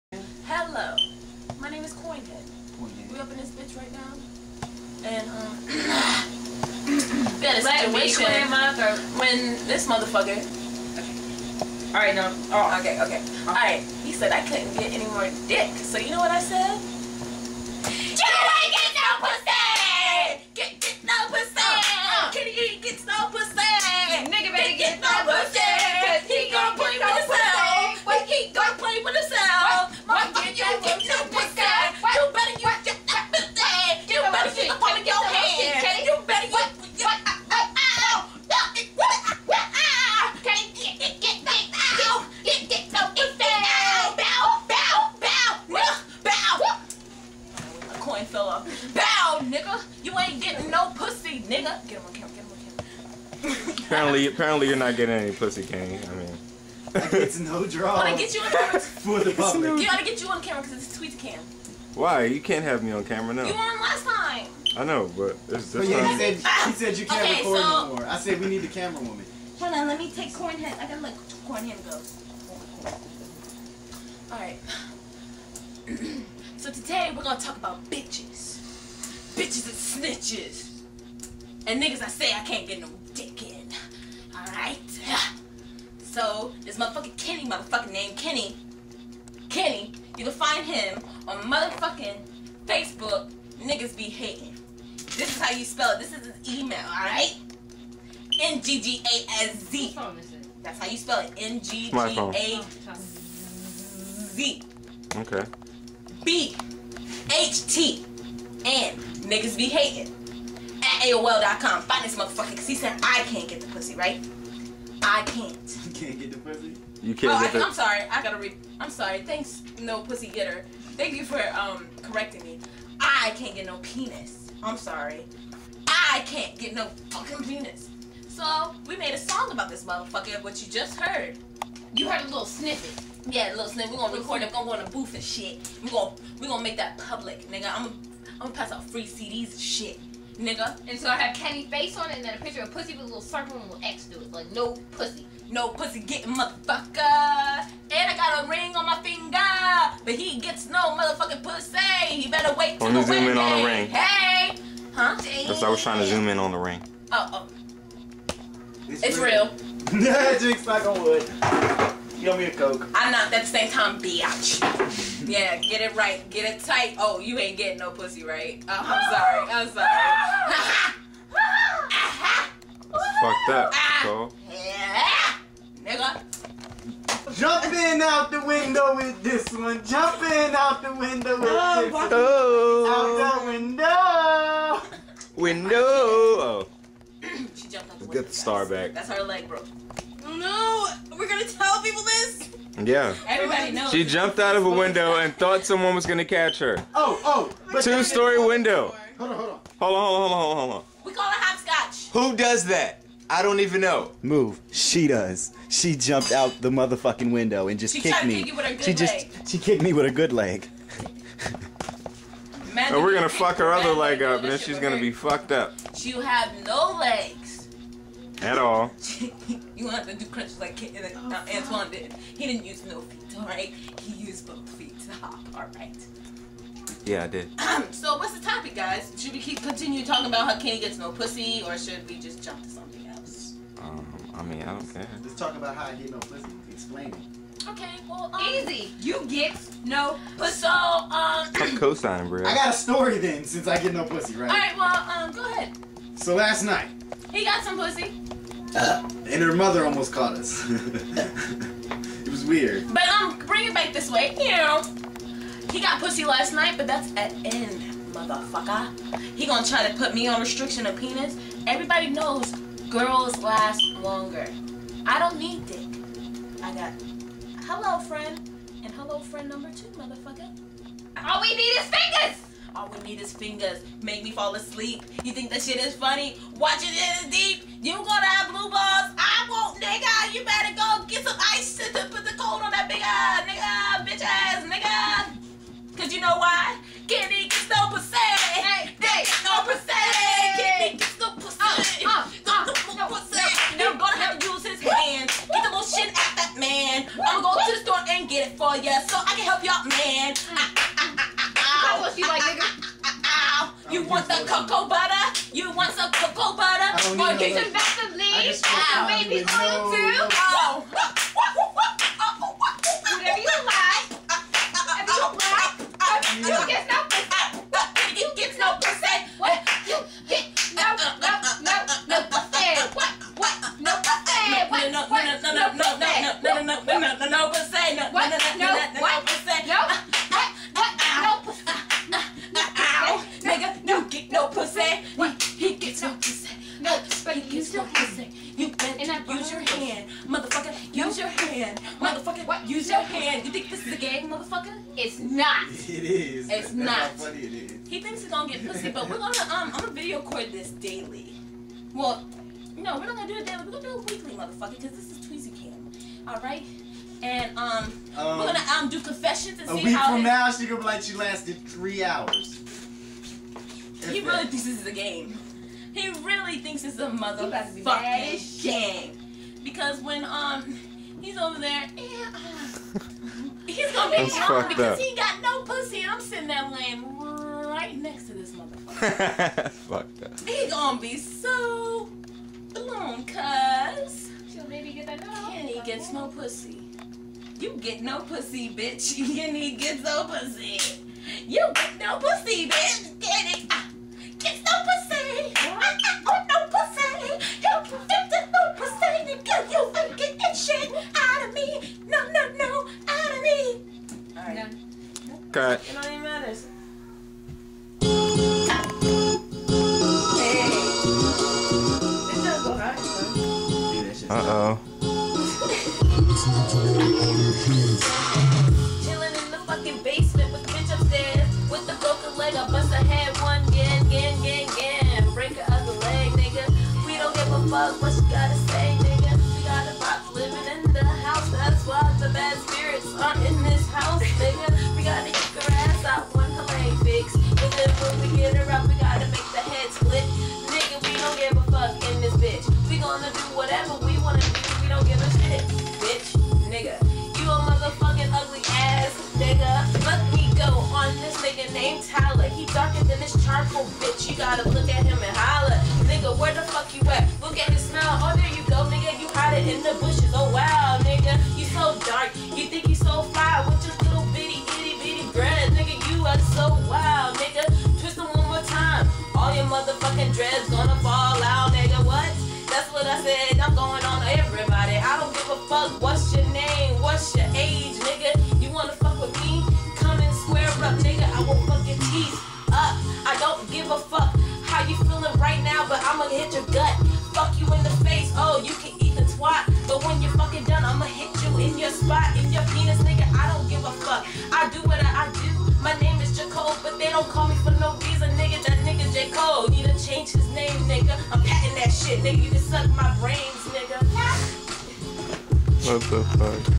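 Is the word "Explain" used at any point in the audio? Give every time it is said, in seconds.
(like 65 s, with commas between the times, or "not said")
236 s.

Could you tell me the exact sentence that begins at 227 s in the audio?
Um, so what's the topic, guys?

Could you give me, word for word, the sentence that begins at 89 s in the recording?
Kenny, you can find him on motherfucking Facebook.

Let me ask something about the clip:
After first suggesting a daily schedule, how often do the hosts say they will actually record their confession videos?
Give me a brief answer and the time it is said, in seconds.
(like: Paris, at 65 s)
Weekly, at 354 s.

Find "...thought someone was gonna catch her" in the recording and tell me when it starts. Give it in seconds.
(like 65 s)
195 s.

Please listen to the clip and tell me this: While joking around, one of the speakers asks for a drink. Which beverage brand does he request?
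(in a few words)
Coke.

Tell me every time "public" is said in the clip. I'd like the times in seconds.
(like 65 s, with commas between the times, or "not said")
59 s, 136 s.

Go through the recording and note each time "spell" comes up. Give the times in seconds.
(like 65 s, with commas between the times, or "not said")
95 s, 100 s.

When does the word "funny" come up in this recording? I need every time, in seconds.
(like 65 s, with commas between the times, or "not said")
275 s.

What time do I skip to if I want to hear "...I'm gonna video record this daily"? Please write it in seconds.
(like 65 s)
349 s.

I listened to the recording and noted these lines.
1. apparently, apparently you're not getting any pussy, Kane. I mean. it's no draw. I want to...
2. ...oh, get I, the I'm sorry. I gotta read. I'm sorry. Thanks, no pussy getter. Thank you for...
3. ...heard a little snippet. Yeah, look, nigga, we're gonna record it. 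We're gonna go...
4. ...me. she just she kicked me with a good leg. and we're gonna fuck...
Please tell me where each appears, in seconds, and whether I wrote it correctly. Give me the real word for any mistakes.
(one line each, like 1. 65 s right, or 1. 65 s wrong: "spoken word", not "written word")
1. 53 s right
2. 117 s right
3. 132 s right
4. 208 s right.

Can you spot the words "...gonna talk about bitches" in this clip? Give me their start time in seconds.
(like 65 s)
77 s.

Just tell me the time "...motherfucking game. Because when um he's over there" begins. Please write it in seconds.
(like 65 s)
367 s.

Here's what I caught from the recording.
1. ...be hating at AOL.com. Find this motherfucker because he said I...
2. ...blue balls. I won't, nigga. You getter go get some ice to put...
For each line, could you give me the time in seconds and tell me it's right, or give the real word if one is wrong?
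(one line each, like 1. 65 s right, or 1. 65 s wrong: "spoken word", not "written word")
1. 109 s right
2. 278 s wrong: "better", not "getter".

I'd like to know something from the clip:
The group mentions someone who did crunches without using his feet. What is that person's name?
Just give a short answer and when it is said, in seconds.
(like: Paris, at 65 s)
Antoine, at 221 s.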